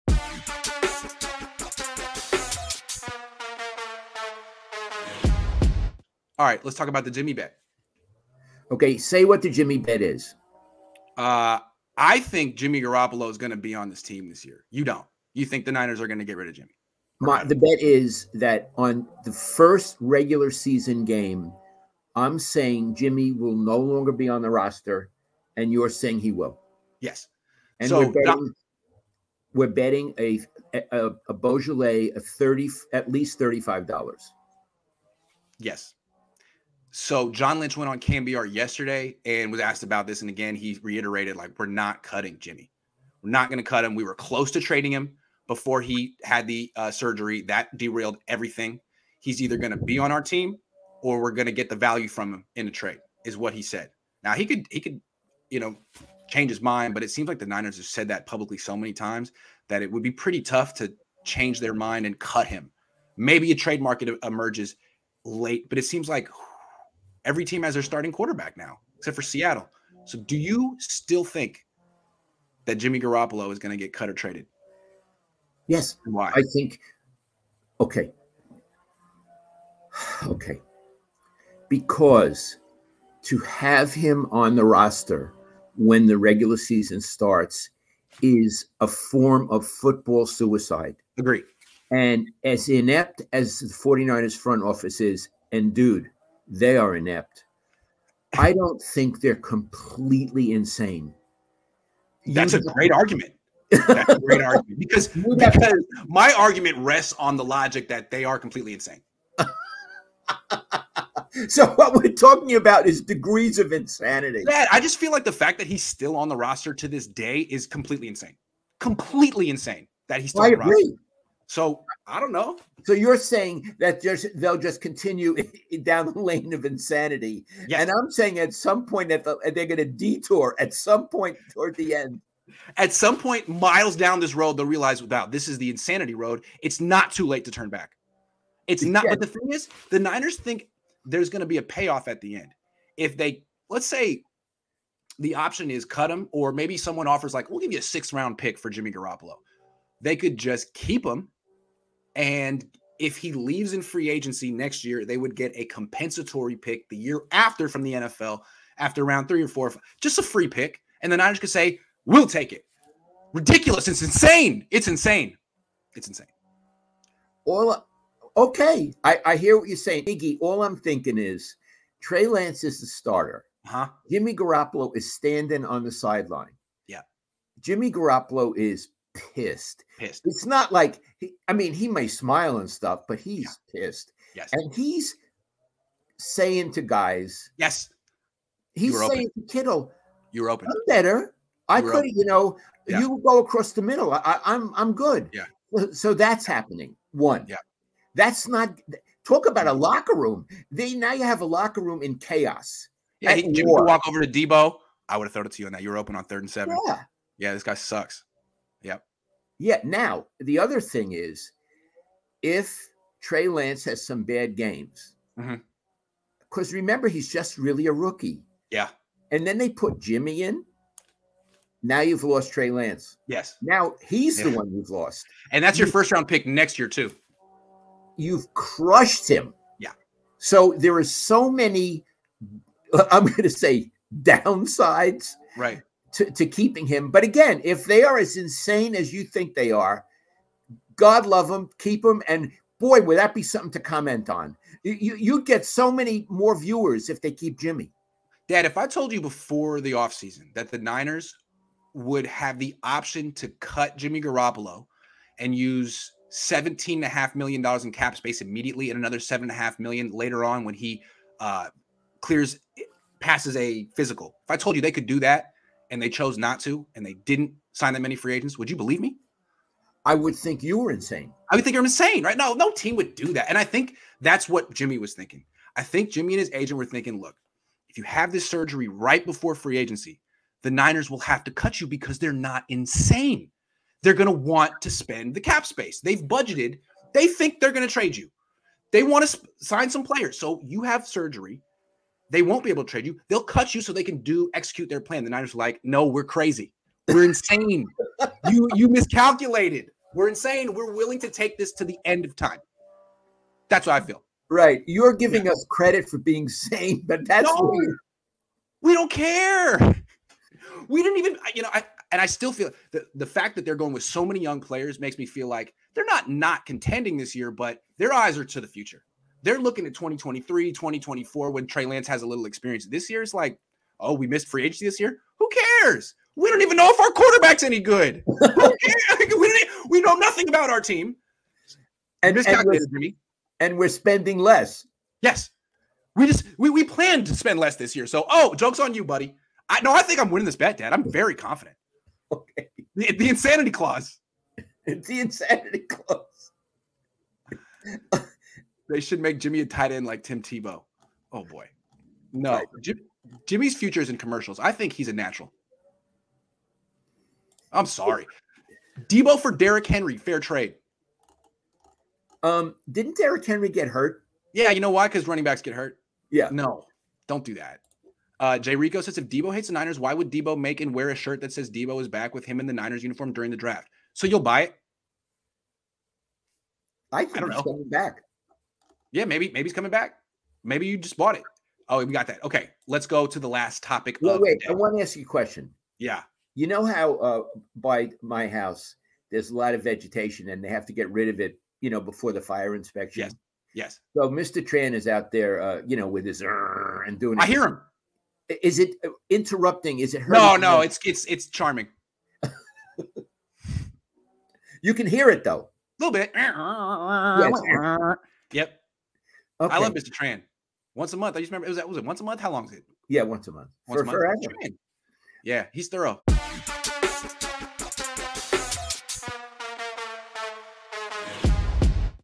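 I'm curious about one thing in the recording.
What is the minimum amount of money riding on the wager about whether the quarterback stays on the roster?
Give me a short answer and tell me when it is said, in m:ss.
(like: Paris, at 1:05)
$35, at 0:33.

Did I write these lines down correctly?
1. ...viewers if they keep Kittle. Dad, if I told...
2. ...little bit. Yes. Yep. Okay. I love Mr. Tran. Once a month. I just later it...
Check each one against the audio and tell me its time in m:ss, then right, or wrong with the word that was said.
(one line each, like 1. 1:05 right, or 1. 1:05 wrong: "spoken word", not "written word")
1. 4:06 wrong: "Jimmy", not "Kittle"
2. 6:46 wrong: "remember", not "later".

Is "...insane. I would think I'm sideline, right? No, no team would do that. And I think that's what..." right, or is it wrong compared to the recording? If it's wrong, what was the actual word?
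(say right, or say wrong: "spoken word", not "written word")
wrong: "insane", not "sideline".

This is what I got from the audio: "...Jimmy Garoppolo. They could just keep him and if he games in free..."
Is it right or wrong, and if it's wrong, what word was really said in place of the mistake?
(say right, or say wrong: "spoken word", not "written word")
wrong: "leaves", not "games".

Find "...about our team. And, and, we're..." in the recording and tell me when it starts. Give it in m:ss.
5:30.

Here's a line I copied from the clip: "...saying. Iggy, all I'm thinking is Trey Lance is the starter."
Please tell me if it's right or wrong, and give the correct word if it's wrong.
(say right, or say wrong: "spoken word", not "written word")
right.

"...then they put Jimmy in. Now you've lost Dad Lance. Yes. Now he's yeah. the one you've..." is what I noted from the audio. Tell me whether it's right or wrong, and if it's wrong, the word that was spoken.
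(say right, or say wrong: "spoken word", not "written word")
wrong: "Trey", not "Dad".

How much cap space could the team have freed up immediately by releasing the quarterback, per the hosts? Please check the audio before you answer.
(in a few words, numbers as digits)
$17.5 million.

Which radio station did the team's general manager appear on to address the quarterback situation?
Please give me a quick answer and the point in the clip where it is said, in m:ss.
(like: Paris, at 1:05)
KNBR, at 0:38.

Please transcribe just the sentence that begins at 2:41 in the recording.
And the Niners could say, we'll take it.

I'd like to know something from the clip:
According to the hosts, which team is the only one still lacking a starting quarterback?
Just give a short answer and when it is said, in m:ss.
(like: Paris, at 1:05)
Seattle, at 1:09.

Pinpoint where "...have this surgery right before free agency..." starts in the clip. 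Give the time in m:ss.
4:38.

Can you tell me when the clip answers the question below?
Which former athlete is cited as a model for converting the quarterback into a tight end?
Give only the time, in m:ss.
5:50.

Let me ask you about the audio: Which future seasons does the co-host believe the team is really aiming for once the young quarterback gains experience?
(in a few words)
2023, 2024.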